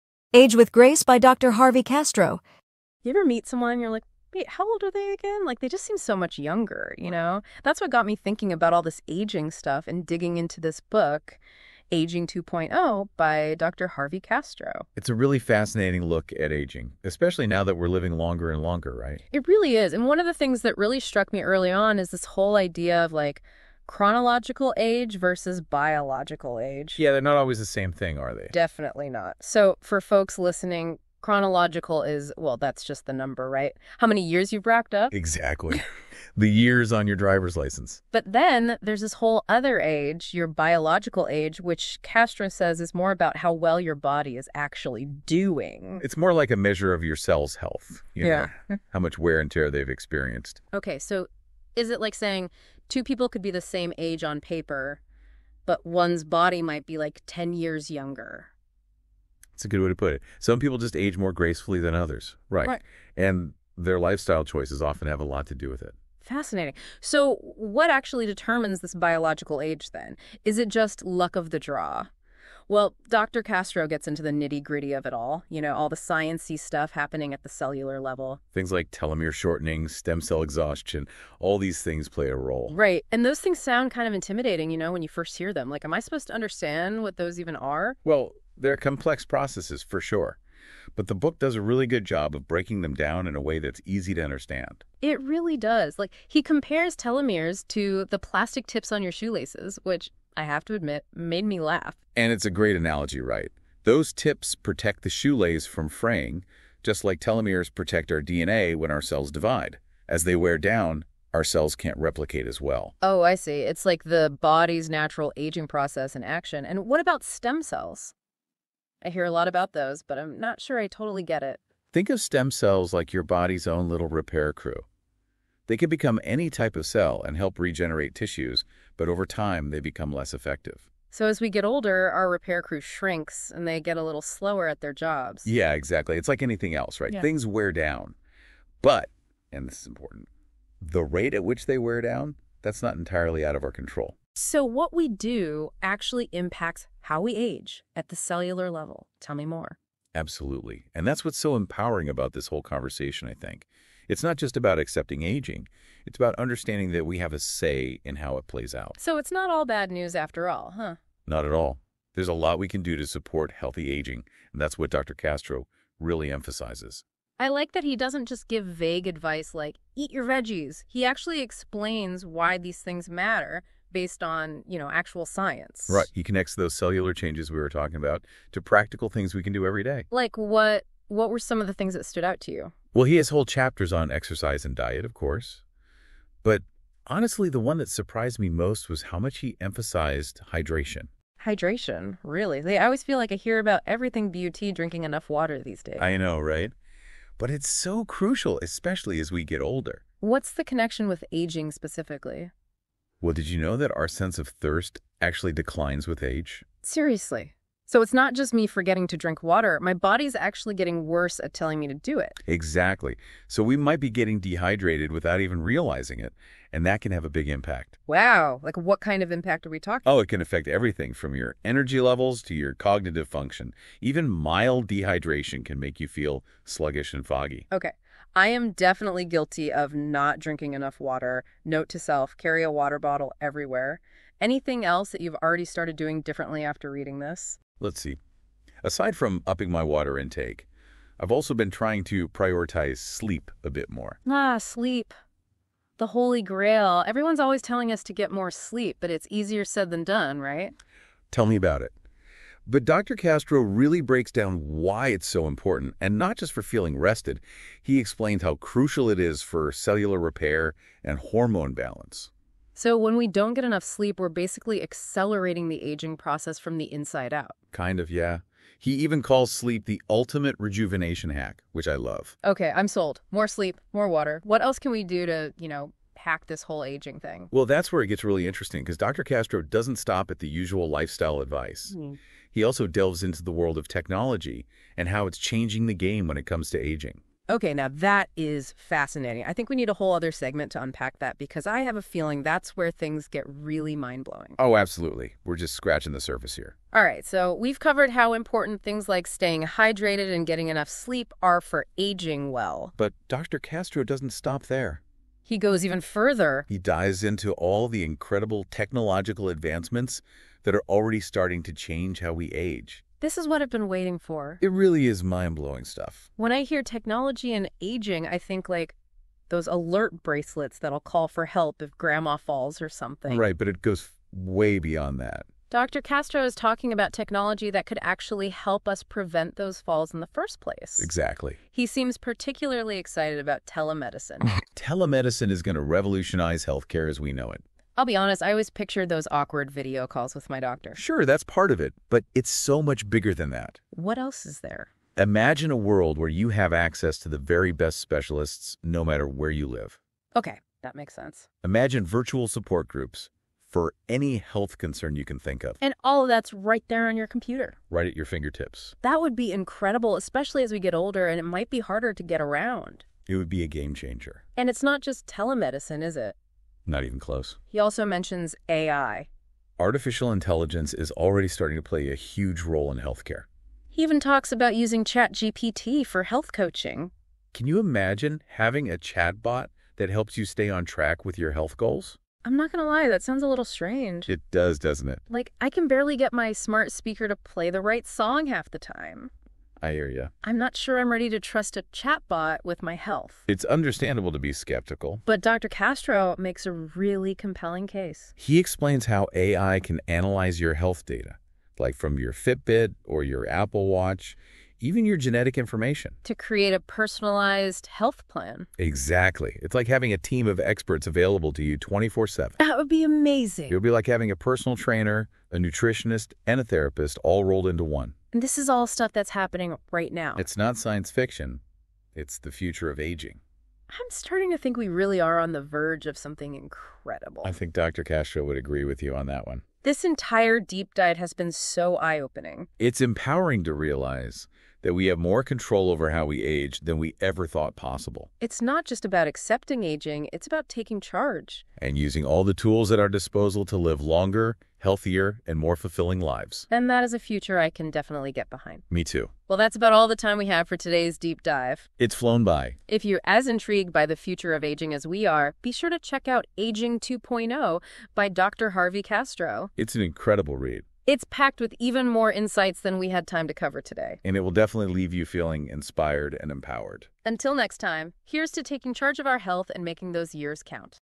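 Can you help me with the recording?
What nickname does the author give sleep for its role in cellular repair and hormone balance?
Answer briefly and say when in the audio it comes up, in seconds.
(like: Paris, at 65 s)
Ultimate rejuvenation hack, at 270 s.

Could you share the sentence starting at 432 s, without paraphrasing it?
It's empowering to realize that we have more control over how we age than we ever thought possible.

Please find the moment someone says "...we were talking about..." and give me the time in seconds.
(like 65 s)
177 s.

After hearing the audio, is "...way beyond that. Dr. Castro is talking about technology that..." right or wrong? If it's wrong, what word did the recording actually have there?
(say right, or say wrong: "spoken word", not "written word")
right.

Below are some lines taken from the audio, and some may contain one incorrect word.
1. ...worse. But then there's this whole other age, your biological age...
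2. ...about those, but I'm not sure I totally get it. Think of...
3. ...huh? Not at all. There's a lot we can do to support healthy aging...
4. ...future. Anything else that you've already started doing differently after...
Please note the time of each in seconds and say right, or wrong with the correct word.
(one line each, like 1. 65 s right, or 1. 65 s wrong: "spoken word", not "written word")
1. 37 s wrong: "license", not "worse"
2. 119 s right
3. 160 s right
4. 233 s wrong: "everywhere", not "future".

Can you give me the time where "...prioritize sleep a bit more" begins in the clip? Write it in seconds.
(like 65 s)
242 s.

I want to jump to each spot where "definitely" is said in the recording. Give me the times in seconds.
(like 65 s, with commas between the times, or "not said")
28 s, 228 s, 447 s, 464 s.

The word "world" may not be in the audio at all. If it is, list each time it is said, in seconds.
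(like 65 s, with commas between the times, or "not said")
283 s, 345 s.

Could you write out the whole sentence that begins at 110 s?
As they wear down, our cells can't replicate as well.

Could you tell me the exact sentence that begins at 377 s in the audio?
Can you imagine having a chatbot that helps you stay on track with your health goals?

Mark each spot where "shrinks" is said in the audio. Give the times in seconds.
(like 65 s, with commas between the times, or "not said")
132 s.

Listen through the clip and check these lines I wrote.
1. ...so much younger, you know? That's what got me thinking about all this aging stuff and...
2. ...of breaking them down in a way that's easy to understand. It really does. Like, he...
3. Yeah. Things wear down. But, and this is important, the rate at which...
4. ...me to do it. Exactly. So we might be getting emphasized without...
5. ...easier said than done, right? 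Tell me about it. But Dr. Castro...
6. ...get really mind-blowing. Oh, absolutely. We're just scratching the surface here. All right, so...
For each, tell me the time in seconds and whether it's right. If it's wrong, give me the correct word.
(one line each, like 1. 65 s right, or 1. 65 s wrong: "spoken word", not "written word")
1. 5 s right
2. 92 s right
3. 137 s right
4. 211 s wrong: "dehydrated", not "emphasized"
5. 249 s right
6. 293 s right.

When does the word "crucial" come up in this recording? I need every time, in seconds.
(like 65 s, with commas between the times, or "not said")
198 s, 258 s.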